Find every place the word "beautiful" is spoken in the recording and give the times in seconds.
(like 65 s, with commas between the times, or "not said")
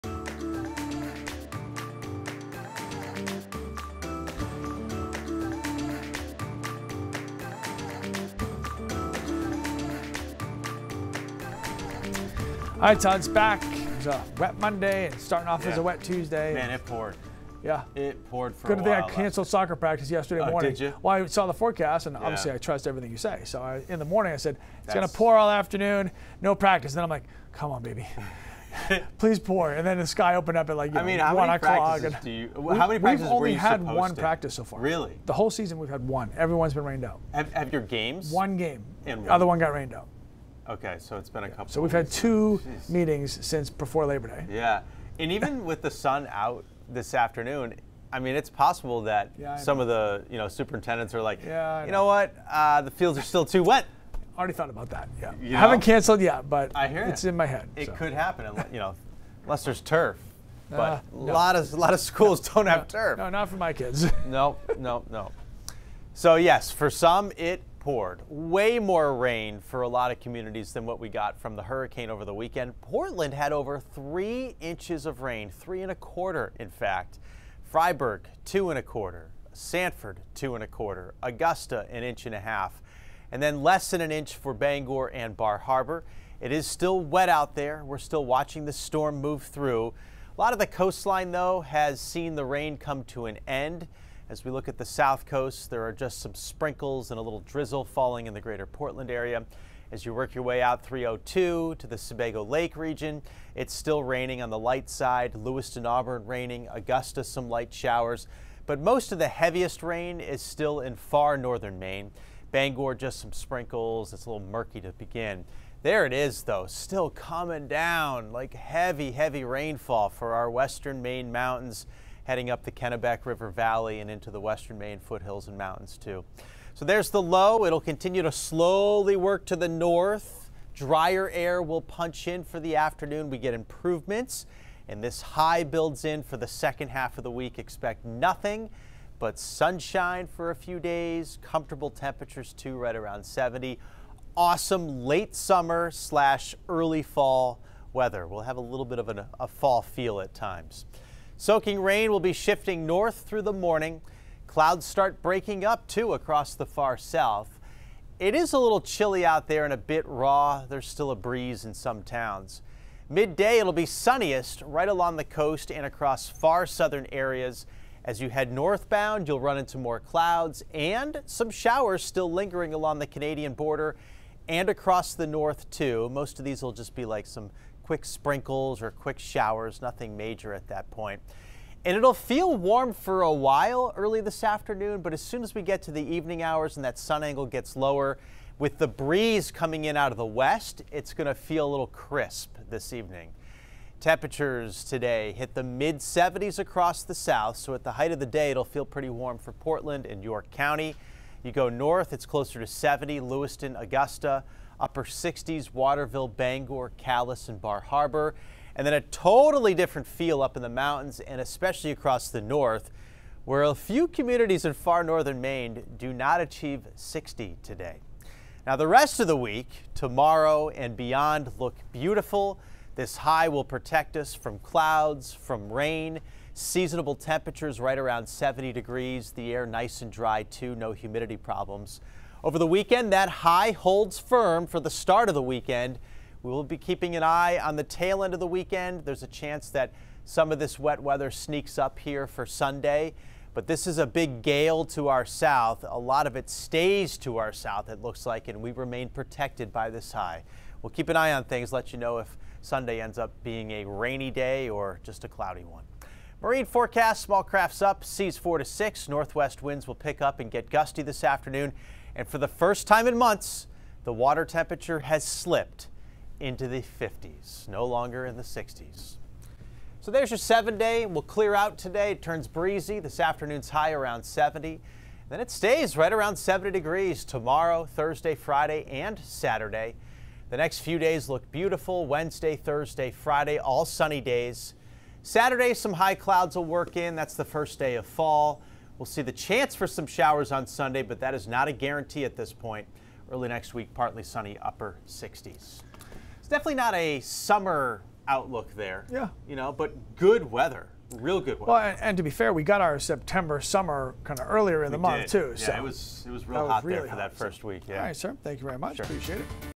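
221 s, 281 s.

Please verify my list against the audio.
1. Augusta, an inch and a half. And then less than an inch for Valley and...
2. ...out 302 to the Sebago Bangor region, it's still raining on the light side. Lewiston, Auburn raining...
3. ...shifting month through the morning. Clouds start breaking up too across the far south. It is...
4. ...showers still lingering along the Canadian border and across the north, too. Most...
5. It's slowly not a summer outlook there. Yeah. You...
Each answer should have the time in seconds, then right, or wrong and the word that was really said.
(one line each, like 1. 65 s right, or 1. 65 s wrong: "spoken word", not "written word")
1. 81 s wrong: "Bangor", not "Valley"
2. 100 s wrong: "Lake", not "Bangor"
3. 152 s wrong: "north", not "month"
4. 171 s right
5. 295 s wrong: "definitely", not "slowly".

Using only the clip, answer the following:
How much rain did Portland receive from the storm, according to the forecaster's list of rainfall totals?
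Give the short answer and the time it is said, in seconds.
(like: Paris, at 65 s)
3.25 inches, at 75 s.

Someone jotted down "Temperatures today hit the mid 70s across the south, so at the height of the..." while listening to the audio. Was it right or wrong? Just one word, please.
right.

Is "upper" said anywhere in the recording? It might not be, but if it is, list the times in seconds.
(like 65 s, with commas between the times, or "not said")
204 s, 294 s.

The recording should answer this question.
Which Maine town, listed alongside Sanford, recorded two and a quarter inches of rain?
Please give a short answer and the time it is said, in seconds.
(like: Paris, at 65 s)
Fryeburg, at 77 s.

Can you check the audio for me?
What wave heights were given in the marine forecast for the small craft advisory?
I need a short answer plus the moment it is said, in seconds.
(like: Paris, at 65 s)
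4 to 6, at 258 s.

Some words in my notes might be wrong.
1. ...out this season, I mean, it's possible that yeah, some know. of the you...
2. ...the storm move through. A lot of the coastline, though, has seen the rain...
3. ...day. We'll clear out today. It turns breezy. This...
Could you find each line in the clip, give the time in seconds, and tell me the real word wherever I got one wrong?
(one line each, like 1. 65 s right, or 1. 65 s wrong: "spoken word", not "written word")
1. 46 s wrong: "afternoon", not "season"
2. 88 s right
3. 270 s right.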